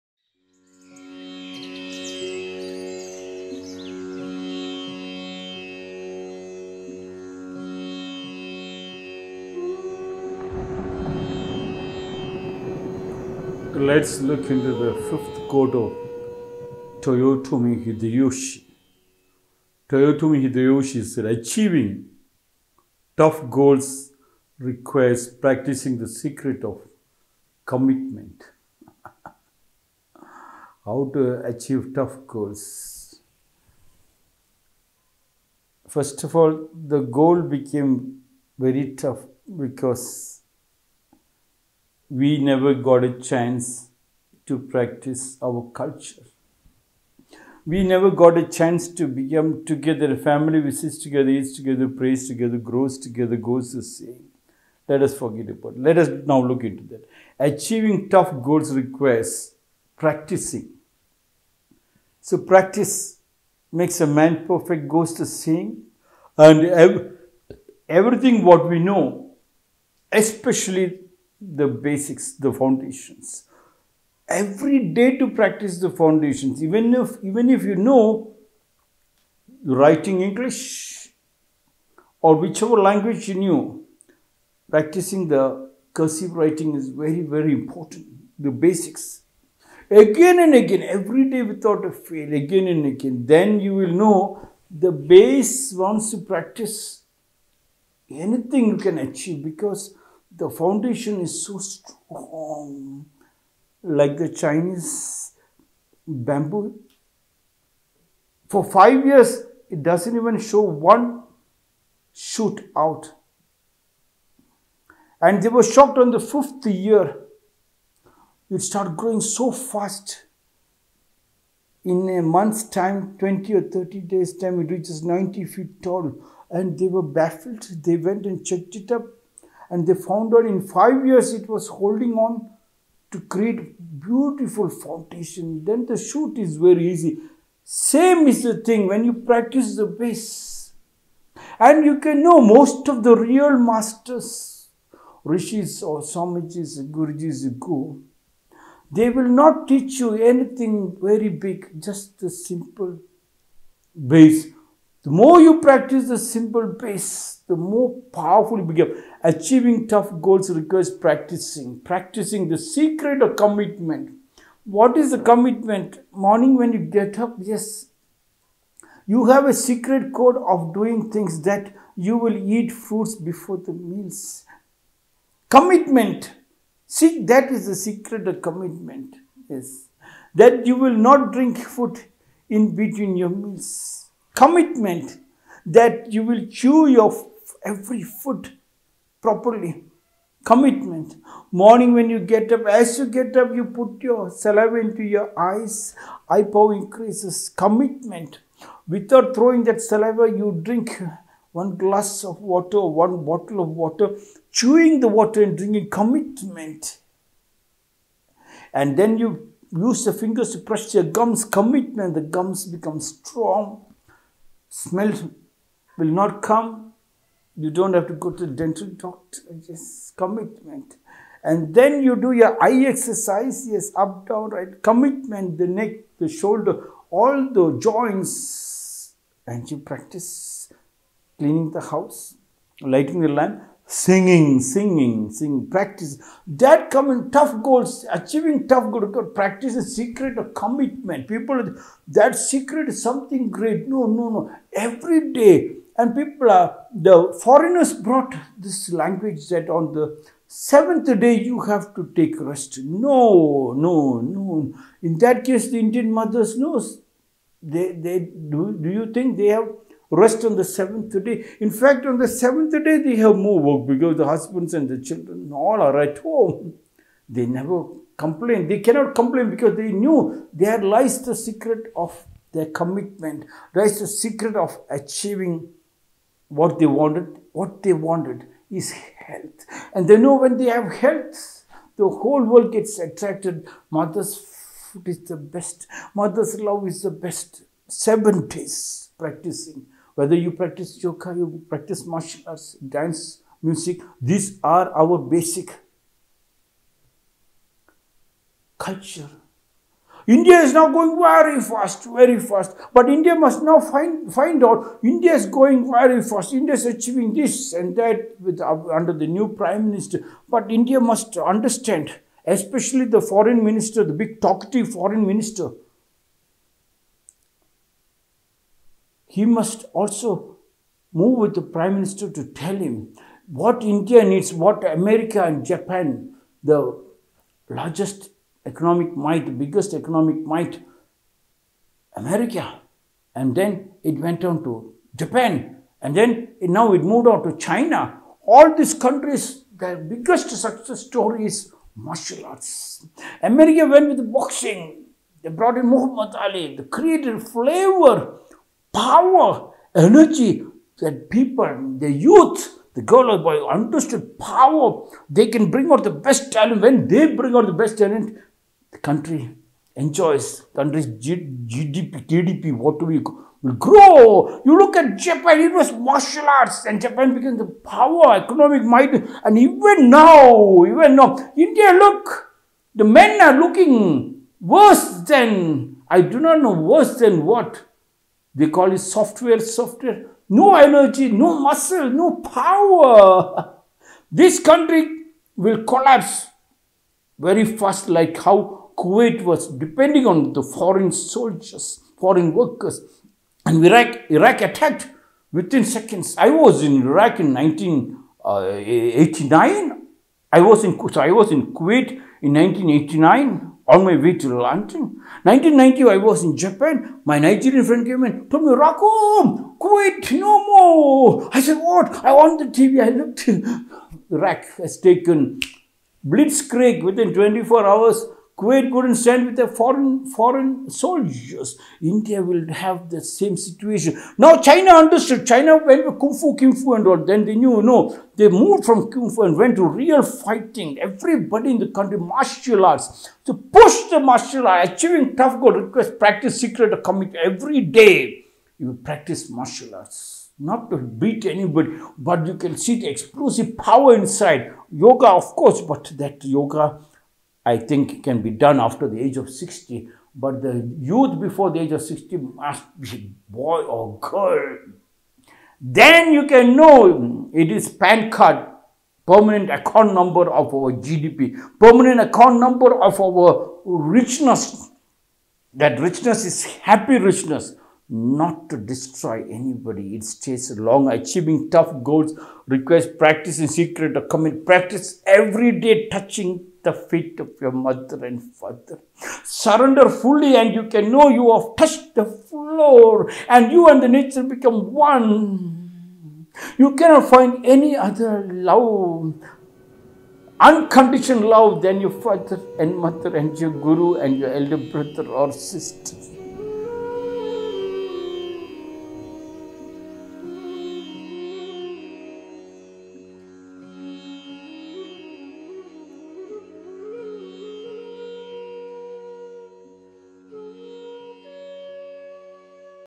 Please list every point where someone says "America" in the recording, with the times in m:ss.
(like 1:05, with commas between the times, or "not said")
5:24, 5:32, 5:43.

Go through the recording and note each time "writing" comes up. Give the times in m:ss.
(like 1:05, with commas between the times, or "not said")
1:19, 1:26.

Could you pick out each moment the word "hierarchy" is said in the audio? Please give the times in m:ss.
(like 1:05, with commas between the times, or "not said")
not said.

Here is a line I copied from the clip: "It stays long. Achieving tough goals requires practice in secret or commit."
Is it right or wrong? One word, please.
right.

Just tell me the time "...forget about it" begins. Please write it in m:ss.
0:55.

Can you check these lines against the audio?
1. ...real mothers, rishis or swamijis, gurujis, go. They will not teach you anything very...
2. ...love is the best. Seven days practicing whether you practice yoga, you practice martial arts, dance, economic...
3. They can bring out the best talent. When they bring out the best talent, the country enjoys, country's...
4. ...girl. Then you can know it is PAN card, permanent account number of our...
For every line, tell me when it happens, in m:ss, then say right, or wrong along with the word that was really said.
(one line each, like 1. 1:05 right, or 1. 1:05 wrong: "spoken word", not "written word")
1. 2:23 wrong: "masters", not "mothers"
2. 4:46 wrong: "music", not "economic"
3. 5:55 right
4. 7:34 right.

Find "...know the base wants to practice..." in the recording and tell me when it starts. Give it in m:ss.
1:33.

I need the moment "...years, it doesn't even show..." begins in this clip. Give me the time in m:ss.
1:49.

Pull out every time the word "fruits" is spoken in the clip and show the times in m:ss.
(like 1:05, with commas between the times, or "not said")
2:52.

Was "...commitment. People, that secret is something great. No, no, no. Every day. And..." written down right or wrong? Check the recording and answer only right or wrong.
right.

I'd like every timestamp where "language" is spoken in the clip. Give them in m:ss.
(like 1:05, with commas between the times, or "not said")
1:22, 4:08.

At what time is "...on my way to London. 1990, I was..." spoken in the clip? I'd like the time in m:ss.
6:43.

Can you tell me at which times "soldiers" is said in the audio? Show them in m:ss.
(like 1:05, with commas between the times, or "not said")
6:31, 7:00.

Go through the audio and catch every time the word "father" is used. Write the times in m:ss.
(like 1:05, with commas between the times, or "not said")
7:58, 8:12.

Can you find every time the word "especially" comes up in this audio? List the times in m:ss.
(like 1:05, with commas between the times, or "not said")
1:10, 5:12.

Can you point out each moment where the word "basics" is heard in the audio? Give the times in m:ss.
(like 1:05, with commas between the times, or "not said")
1:11, 1:28, 4:55.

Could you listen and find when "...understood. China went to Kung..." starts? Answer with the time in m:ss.
7:05.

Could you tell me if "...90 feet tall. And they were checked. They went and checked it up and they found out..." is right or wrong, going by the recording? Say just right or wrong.
wrong.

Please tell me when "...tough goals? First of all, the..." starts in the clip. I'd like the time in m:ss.
0:31.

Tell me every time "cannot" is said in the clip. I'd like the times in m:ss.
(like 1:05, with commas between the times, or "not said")
4:28, 8:06.